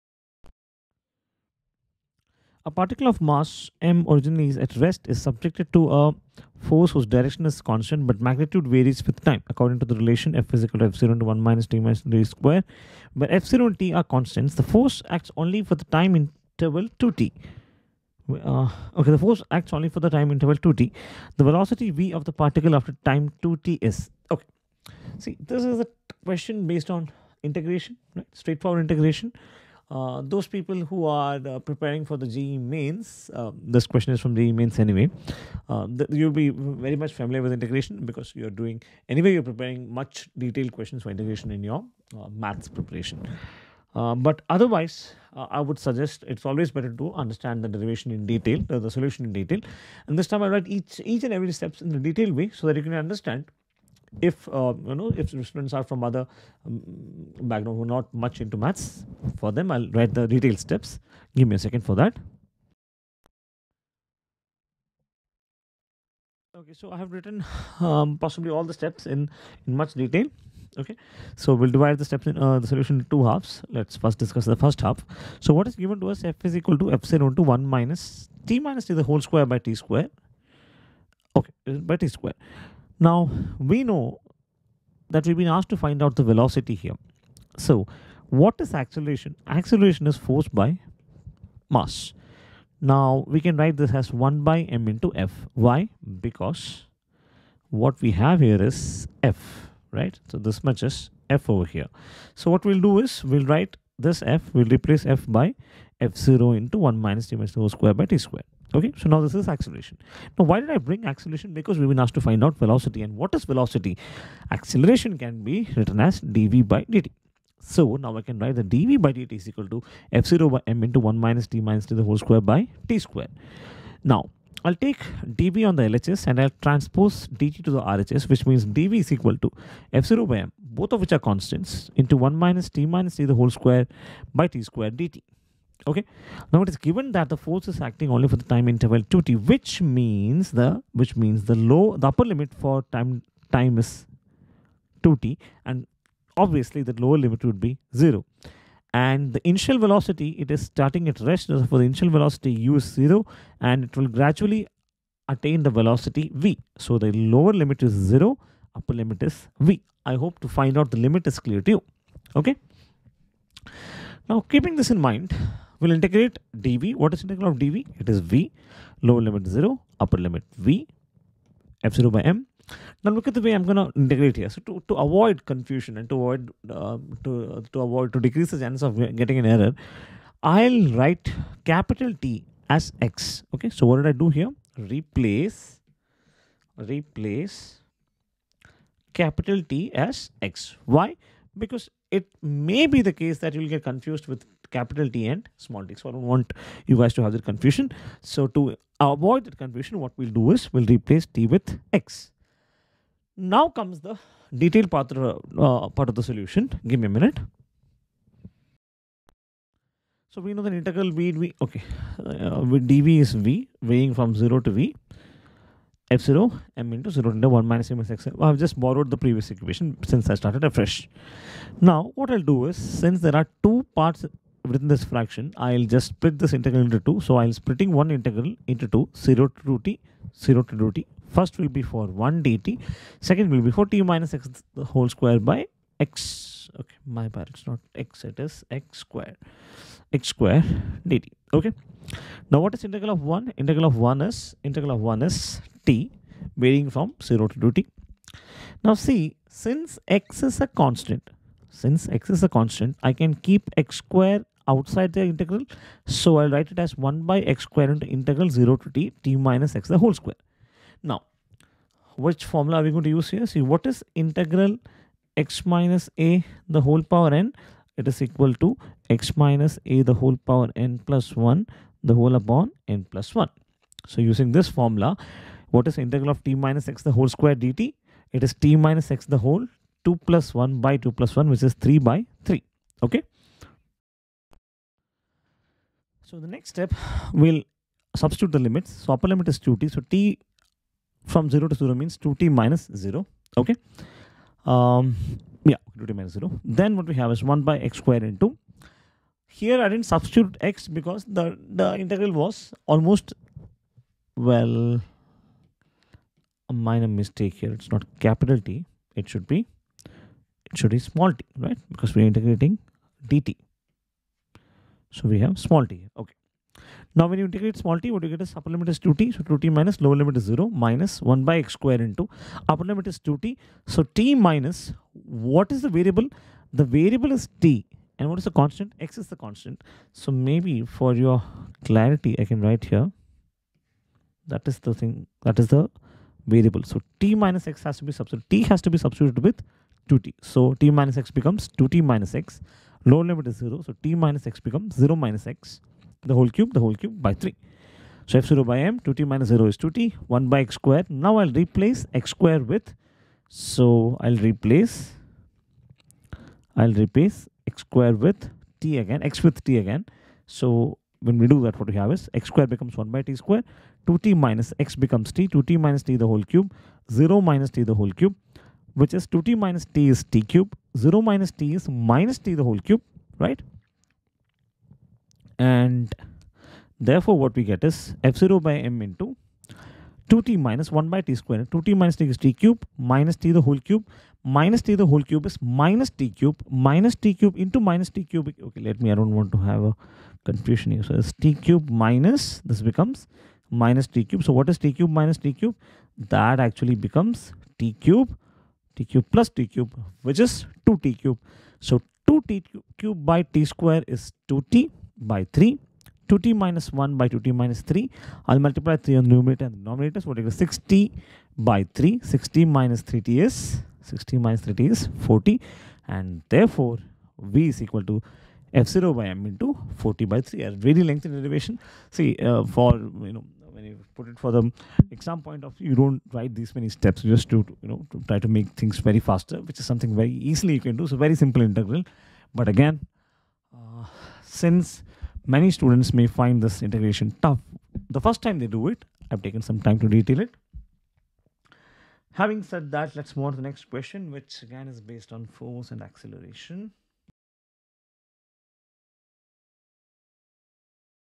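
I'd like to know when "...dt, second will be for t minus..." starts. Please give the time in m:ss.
3:52.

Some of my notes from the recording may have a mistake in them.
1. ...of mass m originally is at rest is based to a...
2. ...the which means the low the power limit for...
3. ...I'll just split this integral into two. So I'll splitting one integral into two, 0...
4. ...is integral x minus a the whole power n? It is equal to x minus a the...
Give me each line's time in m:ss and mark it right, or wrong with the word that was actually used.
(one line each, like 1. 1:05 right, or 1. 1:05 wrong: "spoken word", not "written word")
1. 0:03 wrong: "subjected", not "based"
2. 2:20 wrong: "upper", not "power"
3. 3:45 right
4. 4:23 right.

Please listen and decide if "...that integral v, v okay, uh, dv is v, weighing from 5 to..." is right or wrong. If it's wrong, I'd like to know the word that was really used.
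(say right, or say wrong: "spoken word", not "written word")
wrong: "0", not "5".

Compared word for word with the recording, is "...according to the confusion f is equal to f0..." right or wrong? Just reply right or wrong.
wrong.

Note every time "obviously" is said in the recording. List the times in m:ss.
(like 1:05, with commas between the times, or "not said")
2:26.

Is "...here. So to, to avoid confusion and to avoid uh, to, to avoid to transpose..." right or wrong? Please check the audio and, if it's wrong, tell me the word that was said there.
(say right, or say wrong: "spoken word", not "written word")
wrong: "decrease", not "transpose".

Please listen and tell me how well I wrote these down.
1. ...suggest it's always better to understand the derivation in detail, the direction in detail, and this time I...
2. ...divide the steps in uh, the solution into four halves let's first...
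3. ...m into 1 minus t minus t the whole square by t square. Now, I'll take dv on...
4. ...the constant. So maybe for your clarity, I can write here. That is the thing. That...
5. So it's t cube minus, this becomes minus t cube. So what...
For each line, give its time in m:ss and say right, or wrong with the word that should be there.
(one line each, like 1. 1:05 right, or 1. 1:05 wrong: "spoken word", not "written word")
1. 0:45 wrong: "solution", not "direction"
2. 1:11 wrong: "two", not "four"
3. 2:00 right
4. 5:29 right
5. 6:31 right.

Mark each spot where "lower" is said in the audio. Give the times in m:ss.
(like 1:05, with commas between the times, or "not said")
2:27, 2:37, 2:49, 5:20, 5:43.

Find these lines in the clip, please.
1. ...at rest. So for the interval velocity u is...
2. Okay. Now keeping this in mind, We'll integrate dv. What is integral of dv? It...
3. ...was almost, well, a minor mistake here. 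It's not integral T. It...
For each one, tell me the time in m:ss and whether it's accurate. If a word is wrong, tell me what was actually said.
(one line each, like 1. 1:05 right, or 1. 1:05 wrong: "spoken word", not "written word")
1. 2:31 wrong: "initial", not "interval"
2. 2:42 right
3. 5:02 wrong: "capital", not "integral".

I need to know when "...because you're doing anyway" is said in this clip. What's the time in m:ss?
0:38.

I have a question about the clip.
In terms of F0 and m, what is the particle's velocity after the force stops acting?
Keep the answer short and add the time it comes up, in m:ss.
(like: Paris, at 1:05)
4F0T/3m, at 6:58.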